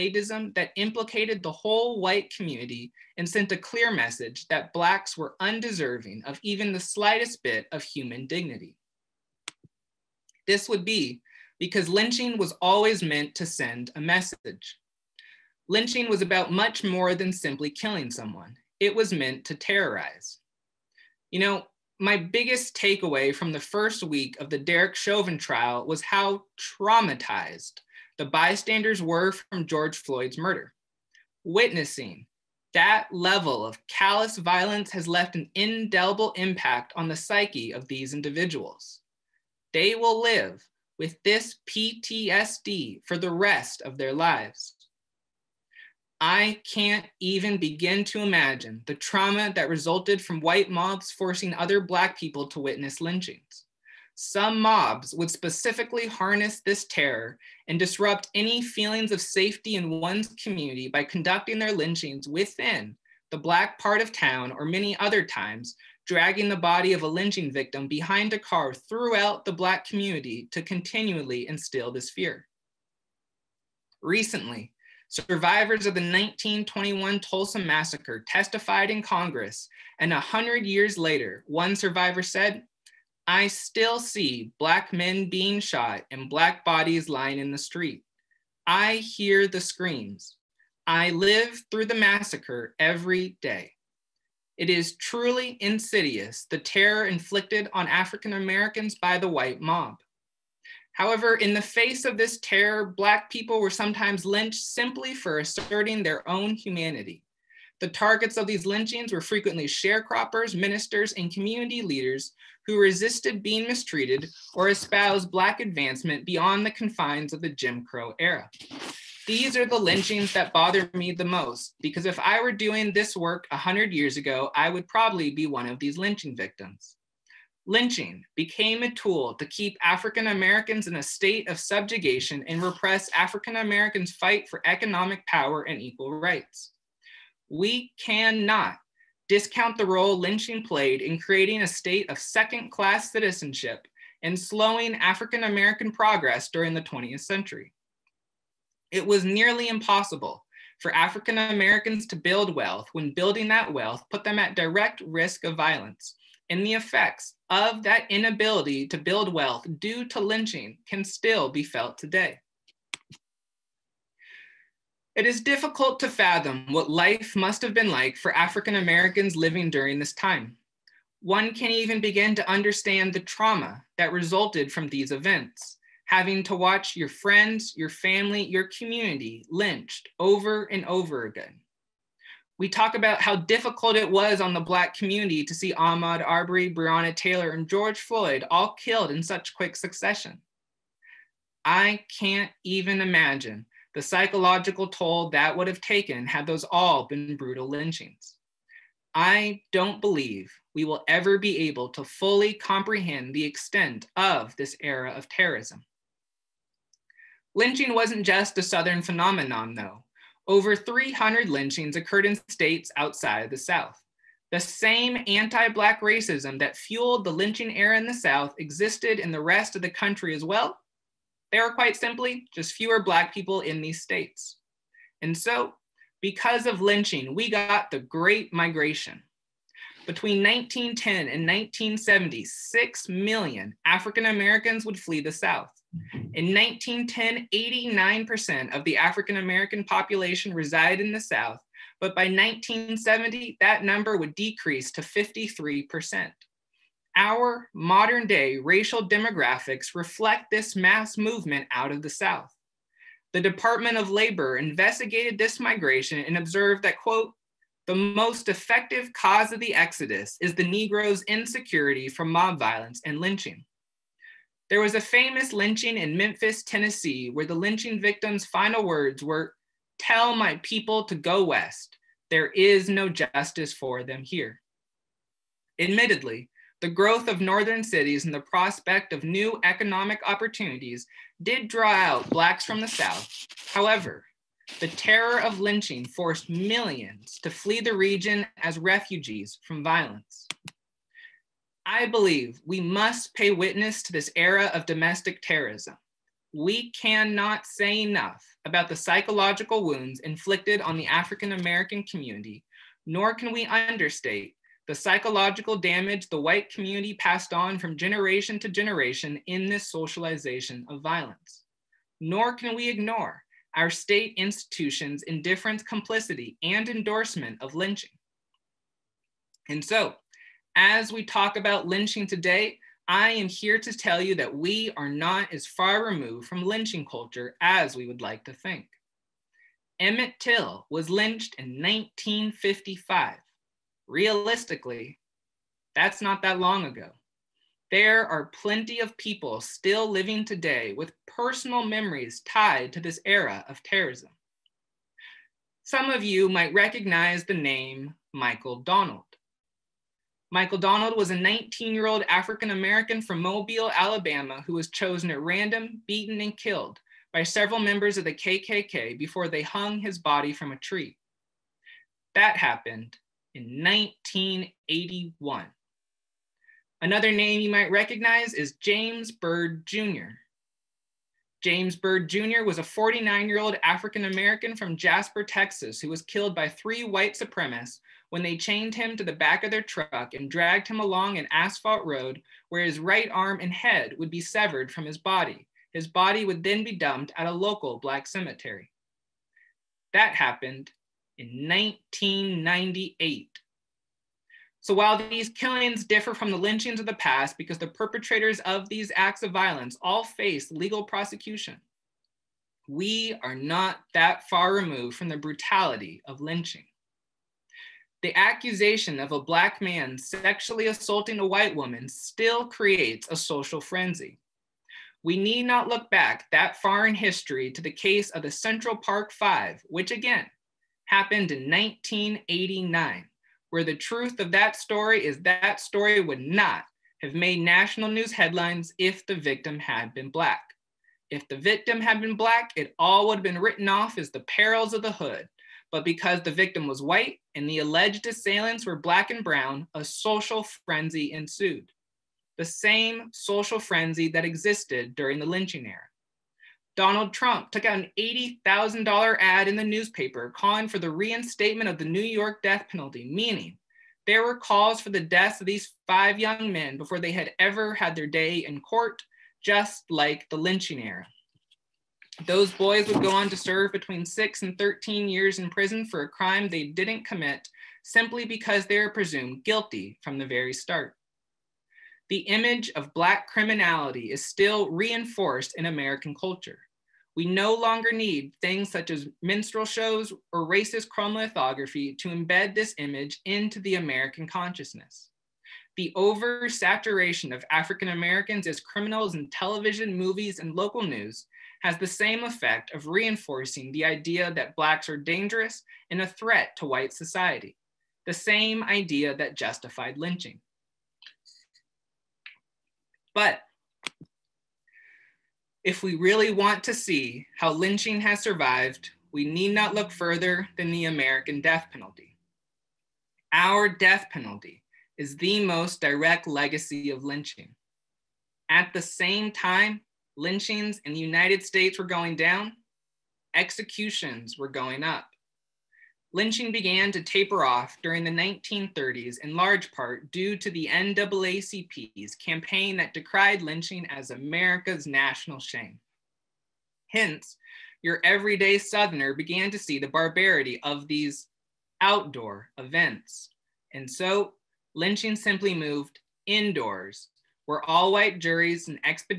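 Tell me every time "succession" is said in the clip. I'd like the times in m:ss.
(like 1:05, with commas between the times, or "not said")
3:09.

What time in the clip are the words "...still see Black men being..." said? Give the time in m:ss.
1:23.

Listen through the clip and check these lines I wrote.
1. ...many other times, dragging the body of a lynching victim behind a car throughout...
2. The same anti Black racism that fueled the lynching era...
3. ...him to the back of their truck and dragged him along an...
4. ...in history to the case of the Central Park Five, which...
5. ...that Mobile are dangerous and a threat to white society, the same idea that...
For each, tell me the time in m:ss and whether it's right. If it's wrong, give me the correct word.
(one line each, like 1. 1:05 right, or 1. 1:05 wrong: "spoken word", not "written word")
1. 1:04 right
2. 3:34 right
3. 6:18 right
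4. 6:57 right
5. 8:14 wrong: "Blacks", not "Mobile".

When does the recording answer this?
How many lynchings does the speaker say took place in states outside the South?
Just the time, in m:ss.
3:30.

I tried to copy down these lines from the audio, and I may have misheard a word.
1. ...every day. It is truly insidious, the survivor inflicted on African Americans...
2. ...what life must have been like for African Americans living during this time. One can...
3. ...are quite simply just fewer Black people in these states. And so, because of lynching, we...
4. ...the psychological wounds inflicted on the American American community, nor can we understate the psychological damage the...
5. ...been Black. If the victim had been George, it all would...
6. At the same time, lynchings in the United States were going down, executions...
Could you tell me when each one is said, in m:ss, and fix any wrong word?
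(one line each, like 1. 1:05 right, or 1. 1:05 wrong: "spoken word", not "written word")
1. 1:32 wrong: "terror", not "survivor"
2. 2:46 right
3. 3:41 right
4. 4:58 wrong: "African", not "American"
5. 7:10 wrong: "Black", not "George"
6. 8:38 right.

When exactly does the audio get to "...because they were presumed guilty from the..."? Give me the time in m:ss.
7:48.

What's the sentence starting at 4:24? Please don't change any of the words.
There was a famous lynching in Memphis, Tennessee, where the lynching victim's final words were, Tell my people to go west.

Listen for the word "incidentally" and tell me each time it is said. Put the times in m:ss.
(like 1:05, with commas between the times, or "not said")
not said.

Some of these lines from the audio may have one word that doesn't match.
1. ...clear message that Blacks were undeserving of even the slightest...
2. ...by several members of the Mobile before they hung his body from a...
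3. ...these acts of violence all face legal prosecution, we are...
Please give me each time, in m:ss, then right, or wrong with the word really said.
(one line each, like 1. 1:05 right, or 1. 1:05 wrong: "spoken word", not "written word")
1. 0:03 right
2. 5:57 wrong: "KKK", not "Mobile"
3. 6:38 right.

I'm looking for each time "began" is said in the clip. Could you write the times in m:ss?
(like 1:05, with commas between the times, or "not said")
8:46, 8:59.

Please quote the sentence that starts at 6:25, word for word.
His body would then be dumped at a local black cemetery.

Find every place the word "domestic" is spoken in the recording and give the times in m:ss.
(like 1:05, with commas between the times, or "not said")
4:54.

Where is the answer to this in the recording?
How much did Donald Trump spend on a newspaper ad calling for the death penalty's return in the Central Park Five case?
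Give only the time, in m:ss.
7:28.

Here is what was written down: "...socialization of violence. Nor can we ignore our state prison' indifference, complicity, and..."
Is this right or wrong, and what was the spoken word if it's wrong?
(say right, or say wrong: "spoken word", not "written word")
wrong: "institutions", not "prison".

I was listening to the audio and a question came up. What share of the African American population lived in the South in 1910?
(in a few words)
89%.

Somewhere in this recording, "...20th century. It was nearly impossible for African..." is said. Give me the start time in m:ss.
2:26.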